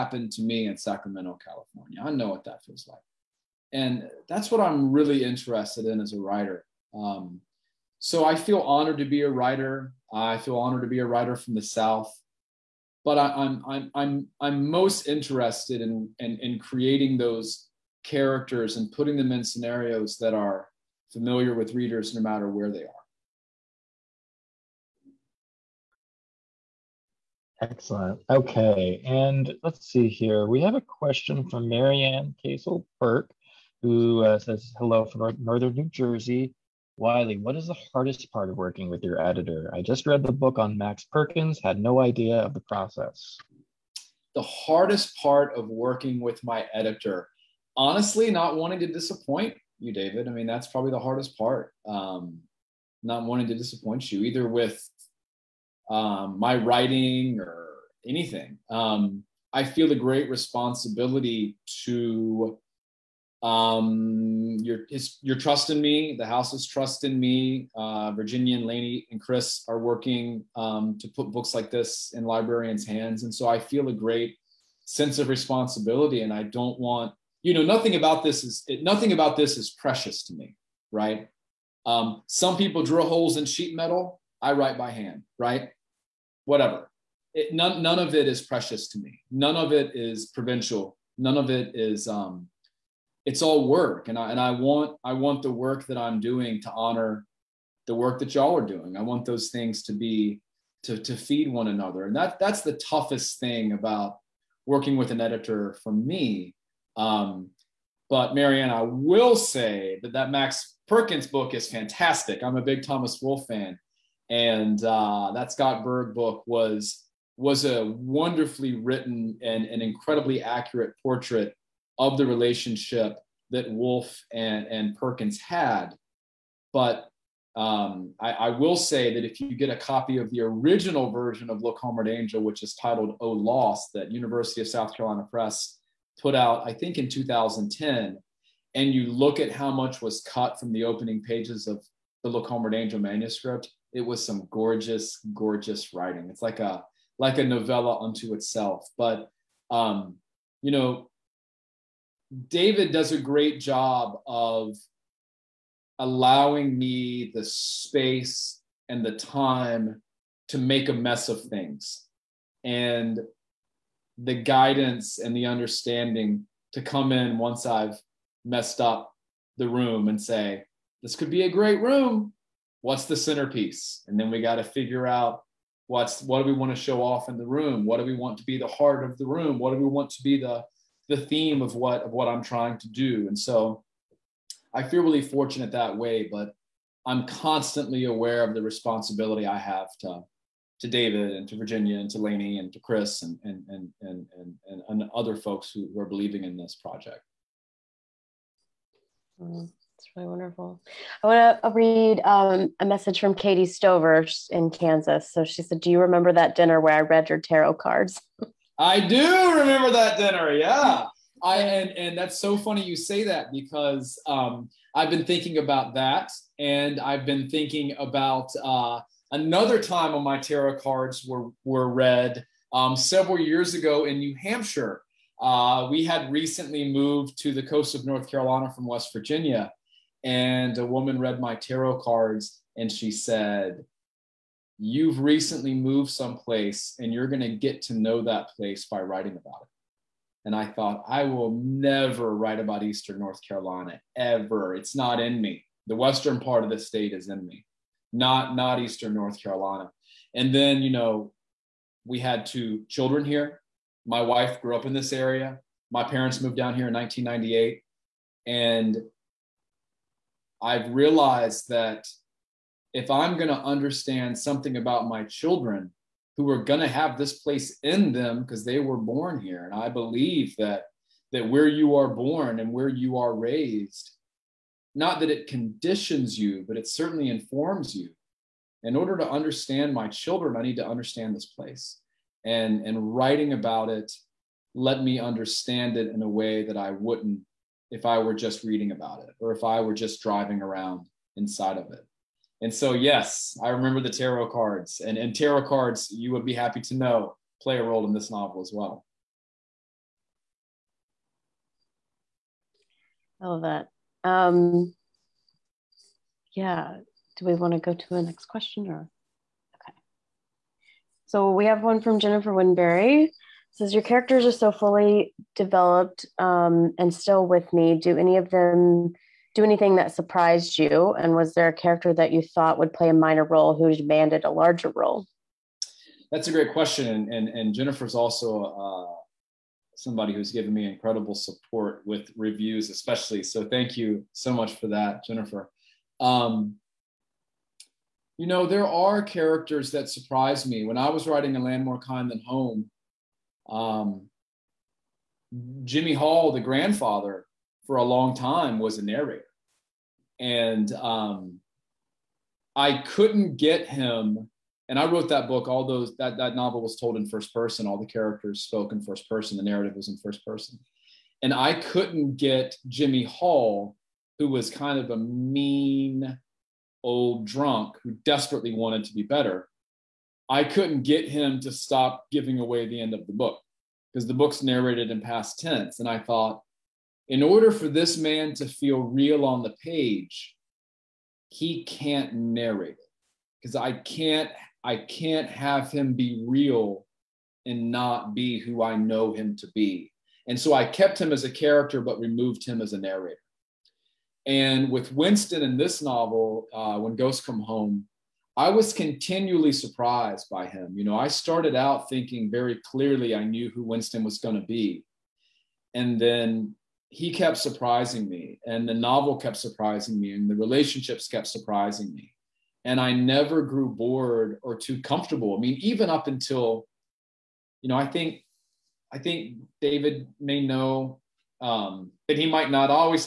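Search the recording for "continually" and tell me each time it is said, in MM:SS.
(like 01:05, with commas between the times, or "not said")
06:38.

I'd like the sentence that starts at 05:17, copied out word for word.
Do any of them do anything that surprised you?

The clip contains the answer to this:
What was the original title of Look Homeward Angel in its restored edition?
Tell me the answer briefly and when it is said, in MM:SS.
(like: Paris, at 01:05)
Oh Lost, at 02:13.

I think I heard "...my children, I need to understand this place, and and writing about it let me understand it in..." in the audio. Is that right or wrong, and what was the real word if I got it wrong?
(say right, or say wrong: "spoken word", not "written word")
right.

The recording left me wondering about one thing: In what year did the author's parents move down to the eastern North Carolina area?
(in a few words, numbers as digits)
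1998.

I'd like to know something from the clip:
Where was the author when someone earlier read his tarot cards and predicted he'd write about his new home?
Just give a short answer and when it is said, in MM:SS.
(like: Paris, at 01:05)
New Hampshire, at 03:44.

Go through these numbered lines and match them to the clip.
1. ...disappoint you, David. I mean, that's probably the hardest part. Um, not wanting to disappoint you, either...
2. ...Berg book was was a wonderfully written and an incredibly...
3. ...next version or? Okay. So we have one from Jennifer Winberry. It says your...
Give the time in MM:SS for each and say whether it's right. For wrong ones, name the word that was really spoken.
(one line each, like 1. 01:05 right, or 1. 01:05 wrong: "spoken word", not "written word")
1. 00:48 right
2. 01:55 right
3. 05:08 wrong: "question", not "version".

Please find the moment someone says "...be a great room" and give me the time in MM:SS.
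02:51.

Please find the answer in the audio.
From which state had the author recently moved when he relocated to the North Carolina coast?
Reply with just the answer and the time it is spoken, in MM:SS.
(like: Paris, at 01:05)
West Virginia, at 03:48.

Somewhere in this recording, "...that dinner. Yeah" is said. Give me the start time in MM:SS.
03:29.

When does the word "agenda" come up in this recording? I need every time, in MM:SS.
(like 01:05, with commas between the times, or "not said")
not said.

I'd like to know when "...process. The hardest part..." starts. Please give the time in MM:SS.
00:42.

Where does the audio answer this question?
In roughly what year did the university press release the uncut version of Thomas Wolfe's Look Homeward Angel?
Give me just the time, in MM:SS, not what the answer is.
02:17.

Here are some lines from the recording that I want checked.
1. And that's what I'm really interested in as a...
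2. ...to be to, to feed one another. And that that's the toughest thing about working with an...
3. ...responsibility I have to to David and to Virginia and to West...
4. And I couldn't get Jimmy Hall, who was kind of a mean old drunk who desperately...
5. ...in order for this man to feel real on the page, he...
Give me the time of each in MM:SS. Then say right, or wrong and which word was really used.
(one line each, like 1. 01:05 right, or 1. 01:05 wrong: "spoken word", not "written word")
1. 00:03 right
2. 01:39 right
3. 03:08 wrong: "Laney", not "West"
4. 06:01 right
5. 06:17 right.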